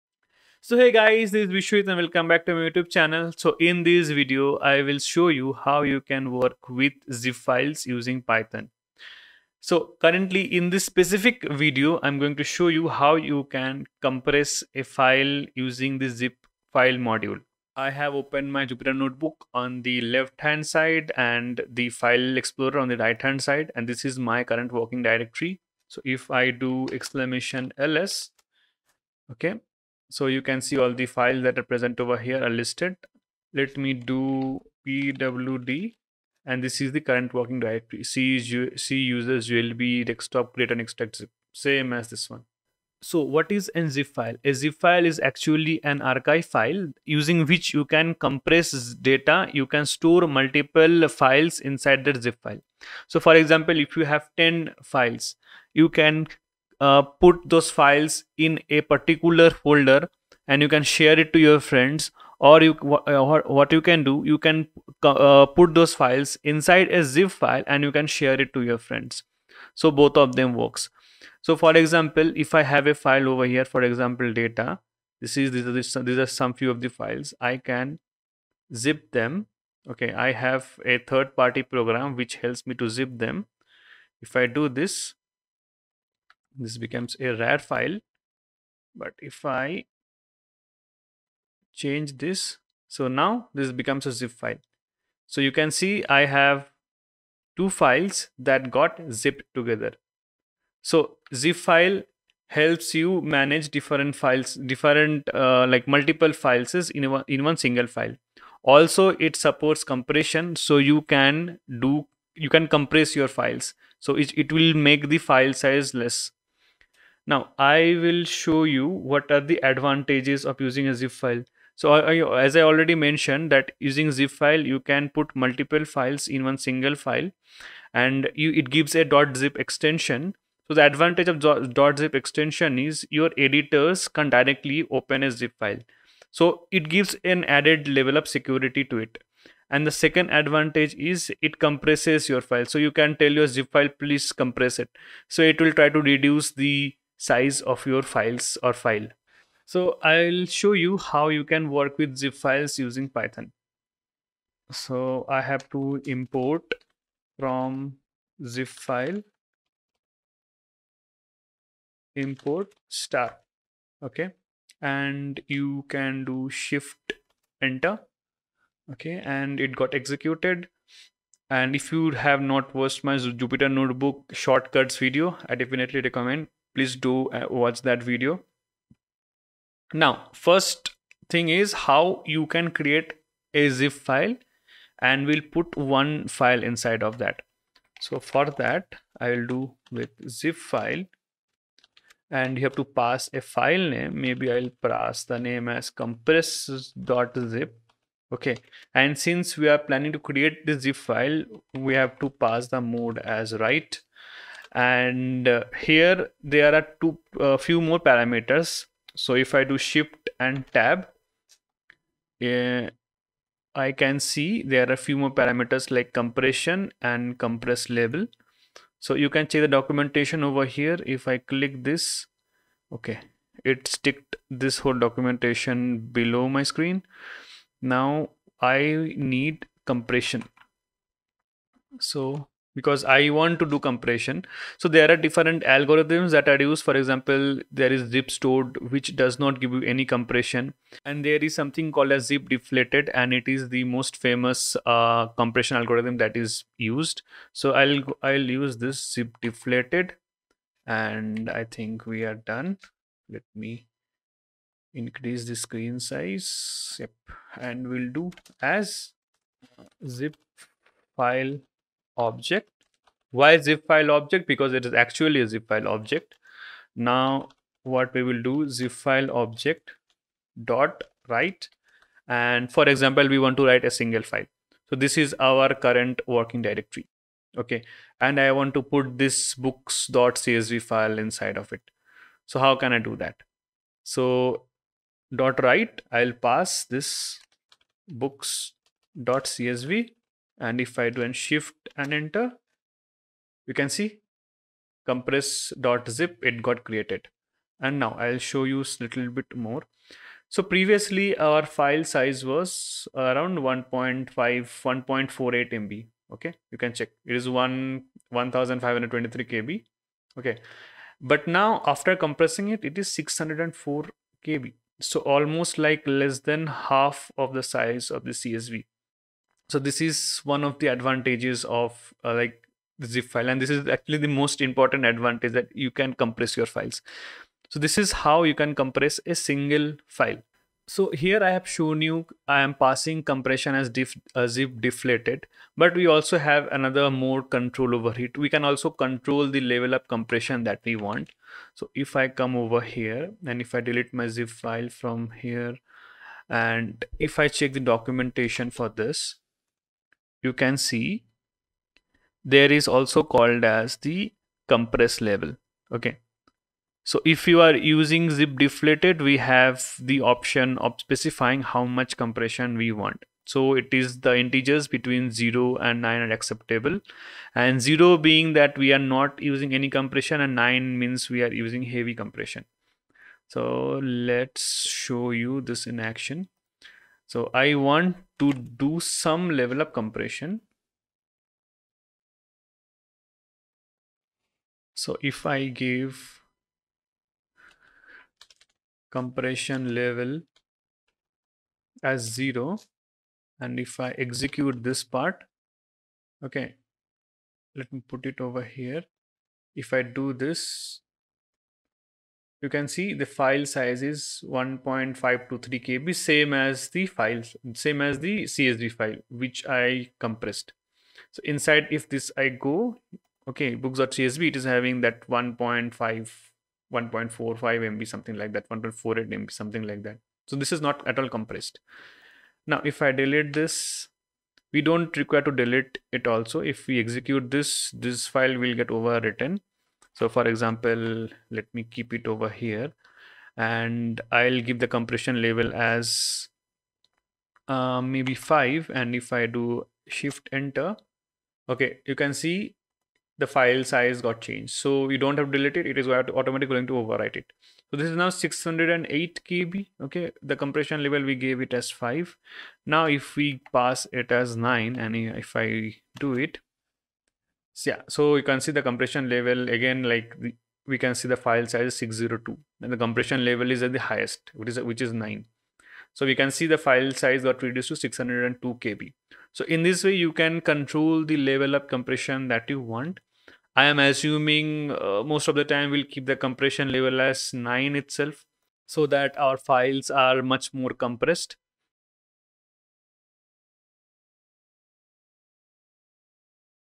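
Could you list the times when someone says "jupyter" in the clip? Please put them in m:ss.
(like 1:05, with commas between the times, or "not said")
0:18, 2:53.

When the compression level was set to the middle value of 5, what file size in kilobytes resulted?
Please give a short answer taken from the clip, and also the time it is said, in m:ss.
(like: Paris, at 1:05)
608 KB, at 7:28.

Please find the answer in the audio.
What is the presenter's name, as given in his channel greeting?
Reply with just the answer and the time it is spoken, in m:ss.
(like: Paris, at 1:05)
Biswajit, at 0:01.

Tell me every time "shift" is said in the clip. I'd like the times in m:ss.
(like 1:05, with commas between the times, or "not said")
2:46, 3:29, 4:51, 7:20.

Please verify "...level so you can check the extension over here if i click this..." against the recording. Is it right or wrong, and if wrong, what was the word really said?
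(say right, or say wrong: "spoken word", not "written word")
wrong: "documentation", not "extension".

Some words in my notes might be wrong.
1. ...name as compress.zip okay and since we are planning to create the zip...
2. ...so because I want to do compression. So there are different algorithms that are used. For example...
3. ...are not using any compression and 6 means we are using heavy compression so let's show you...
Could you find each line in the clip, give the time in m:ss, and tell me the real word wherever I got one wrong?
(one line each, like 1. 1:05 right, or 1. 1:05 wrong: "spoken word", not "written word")
1. 3:15 right
2. 3:51 right
3. 6:08 wrong: "9", not "6".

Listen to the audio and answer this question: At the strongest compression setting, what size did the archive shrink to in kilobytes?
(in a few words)
602 KB.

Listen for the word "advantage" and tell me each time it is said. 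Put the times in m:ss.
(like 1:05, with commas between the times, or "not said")
1:59, 2:10, 2:20, 5:20, 5:25.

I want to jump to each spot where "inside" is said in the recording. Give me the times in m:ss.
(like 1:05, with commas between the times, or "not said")
0:51, 1:06, 3:06, 4:41, 6:51.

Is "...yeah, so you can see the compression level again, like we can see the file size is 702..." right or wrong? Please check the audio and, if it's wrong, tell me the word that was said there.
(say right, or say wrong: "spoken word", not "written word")
wrong: "602", not "702".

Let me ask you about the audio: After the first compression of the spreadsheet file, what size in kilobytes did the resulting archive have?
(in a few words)
604 KB.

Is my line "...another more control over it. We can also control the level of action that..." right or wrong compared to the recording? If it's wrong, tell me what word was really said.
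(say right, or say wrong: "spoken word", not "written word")
wrong: "compression", not "action".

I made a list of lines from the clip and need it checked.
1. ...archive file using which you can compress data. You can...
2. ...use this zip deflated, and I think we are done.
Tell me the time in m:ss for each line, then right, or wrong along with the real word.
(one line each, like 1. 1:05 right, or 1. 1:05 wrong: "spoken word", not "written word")
1. 0:46 right
2. 4:08 right.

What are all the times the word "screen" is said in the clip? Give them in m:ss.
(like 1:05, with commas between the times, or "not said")
3:46, 4:15.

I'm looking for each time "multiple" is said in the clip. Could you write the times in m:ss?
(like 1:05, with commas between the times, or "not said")
0:50, 1:45, 2:05.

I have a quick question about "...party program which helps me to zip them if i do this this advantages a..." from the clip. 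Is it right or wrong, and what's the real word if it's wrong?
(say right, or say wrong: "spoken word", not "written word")
wrong: "becomes", not "advantages".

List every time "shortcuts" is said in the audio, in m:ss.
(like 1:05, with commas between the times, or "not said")
2:54.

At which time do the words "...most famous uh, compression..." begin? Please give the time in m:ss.
4:03.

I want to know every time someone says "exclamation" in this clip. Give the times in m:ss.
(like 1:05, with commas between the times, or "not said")
0:26.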